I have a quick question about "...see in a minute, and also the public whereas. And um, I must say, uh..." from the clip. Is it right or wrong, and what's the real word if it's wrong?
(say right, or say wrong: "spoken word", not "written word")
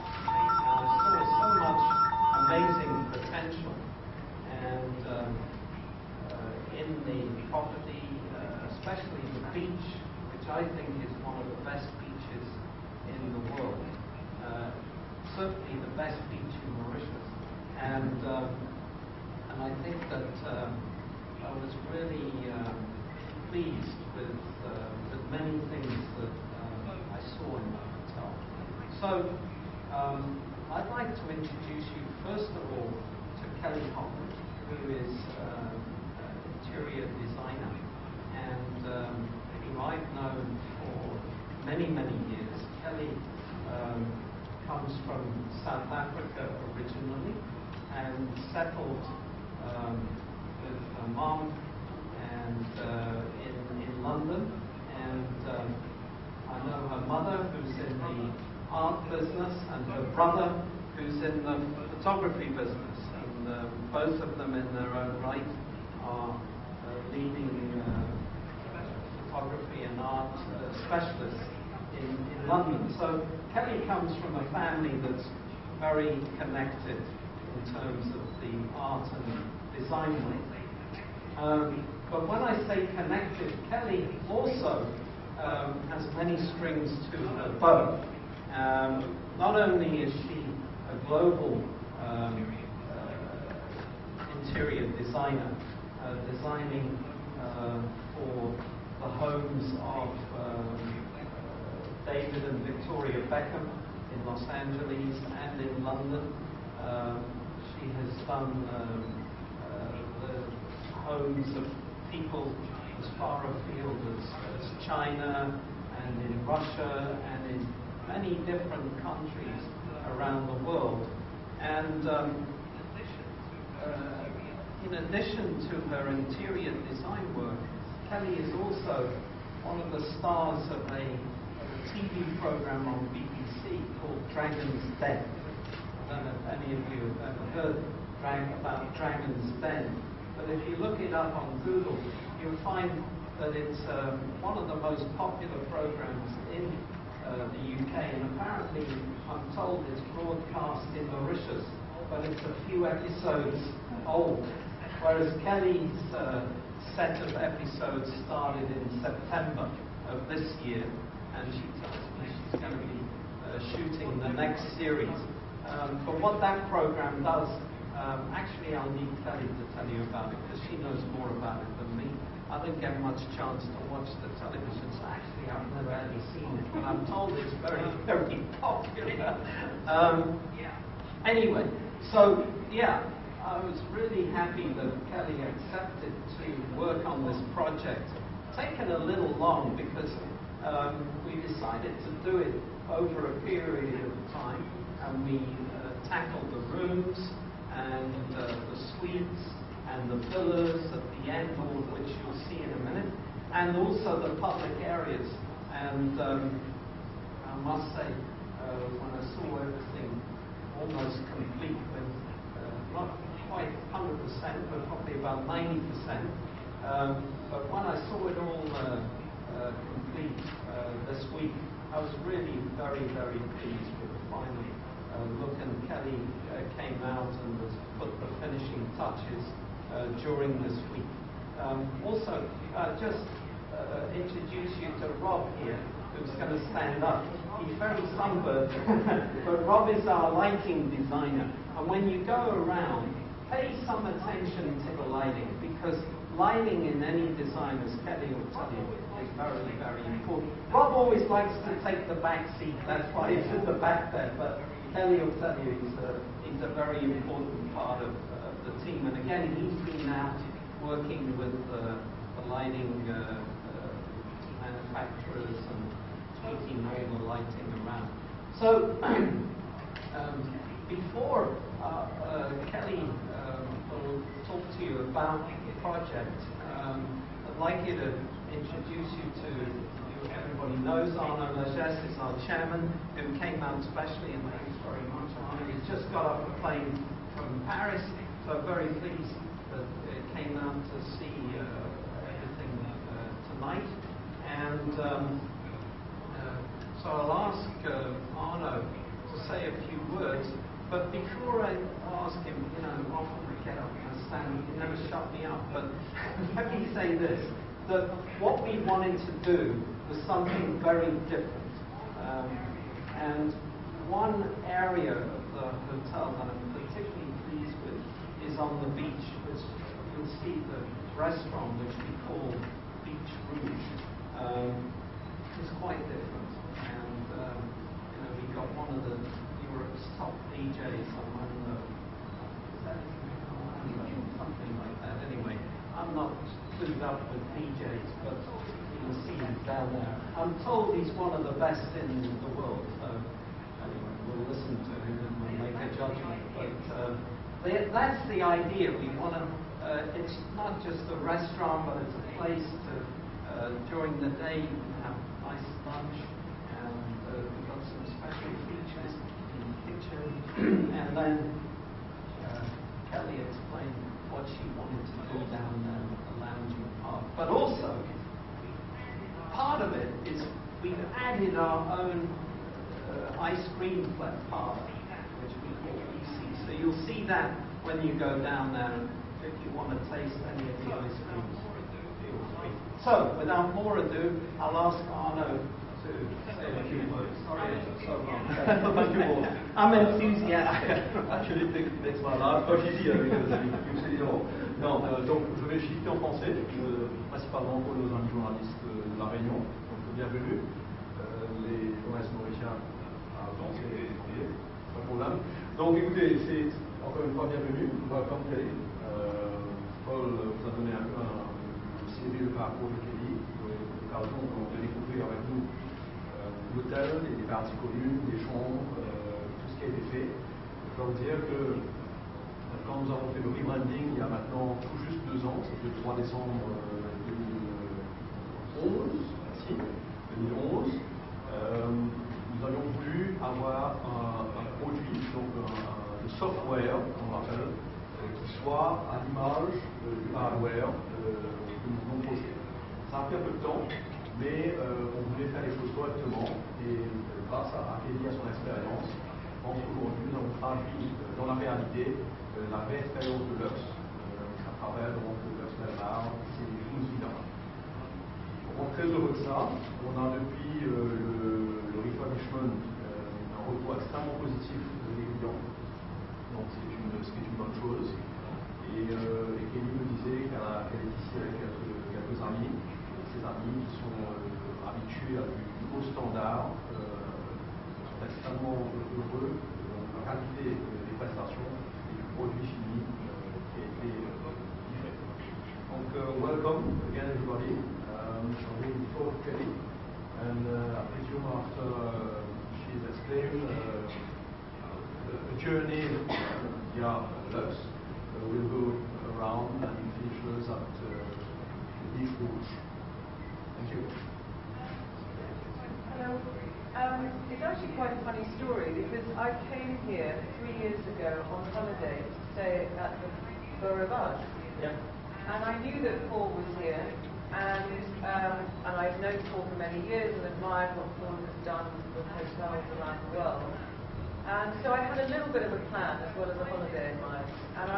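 wrong: "areas", not "whereas".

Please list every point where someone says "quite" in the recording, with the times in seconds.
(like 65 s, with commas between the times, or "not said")
213 s, 325 s, 507 s.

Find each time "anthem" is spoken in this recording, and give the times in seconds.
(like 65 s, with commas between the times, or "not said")
not said.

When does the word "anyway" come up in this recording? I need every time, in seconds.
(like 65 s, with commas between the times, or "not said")
181 s, 335 s, 343 s.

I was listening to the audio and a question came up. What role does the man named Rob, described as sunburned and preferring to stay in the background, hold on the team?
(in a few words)
Lighting designer.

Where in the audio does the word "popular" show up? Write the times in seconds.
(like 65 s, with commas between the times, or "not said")
145 s, 178 s.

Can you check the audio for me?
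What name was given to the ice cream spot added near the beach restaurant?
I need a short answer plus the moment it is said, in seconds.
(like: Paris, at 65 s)
ICI, at 376 s.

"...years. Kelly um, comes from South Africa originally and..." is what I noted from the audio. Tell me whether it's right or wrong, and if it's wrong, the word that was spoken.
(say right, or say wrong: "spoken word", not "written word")
right.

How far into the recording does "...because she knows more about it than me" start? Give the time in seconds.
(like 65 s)
170 s.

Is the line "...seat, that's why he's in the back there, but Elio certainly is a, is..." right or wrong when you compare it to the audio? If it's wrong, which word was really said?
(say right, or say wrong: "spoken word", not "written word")
right.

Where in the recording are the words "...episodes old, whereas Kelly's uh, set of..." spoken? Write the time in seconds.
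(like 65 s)
152 s.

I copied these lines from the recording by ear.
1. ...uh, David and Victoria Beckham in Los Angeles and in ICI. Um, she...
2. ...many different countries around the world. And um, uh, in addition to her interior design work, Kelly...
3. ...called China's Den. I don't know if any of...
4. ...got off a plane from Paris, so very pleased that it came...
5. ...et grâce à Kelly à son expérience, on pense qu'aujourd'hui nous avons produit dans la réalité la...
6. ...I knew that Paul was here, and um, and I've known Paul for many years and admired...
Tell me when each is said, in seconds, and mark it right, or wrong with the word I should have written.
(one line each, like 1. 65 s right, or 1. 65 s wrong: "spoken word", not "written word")
1. 101 s wrong: "London", not "ICI"
2. 118 s right
3. 133 s wrong: "Dragon", not "China"
4. 286 s right
5. 446 s wrong: "traduit", not "produit"
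6. 515 s right.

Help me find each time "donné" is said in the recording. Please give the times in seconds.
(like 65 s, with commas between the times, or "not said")
410 s.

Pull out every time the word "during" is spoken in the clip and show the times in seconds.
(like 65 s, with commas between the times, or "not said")
230 s, 353 s.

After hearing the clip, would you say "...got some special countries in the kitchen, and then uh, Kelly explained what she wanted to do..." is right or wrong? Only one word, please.
wrong.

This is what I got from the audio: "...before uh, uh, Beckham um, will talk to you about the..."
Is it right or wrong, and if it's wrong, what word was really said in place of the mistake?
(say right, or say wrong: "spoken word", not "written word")
wrong: "Kelly", not "Beckham".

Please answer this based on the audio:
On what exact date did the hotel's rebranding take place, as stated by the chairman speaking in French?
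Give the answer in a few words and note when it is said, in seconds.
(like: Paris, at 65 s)
3 December 2011, at 426 s.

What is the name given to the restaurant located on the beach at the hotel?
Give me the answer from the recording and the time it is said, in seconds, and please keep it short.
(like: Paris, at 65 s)
Beach Rouge, at 323 s.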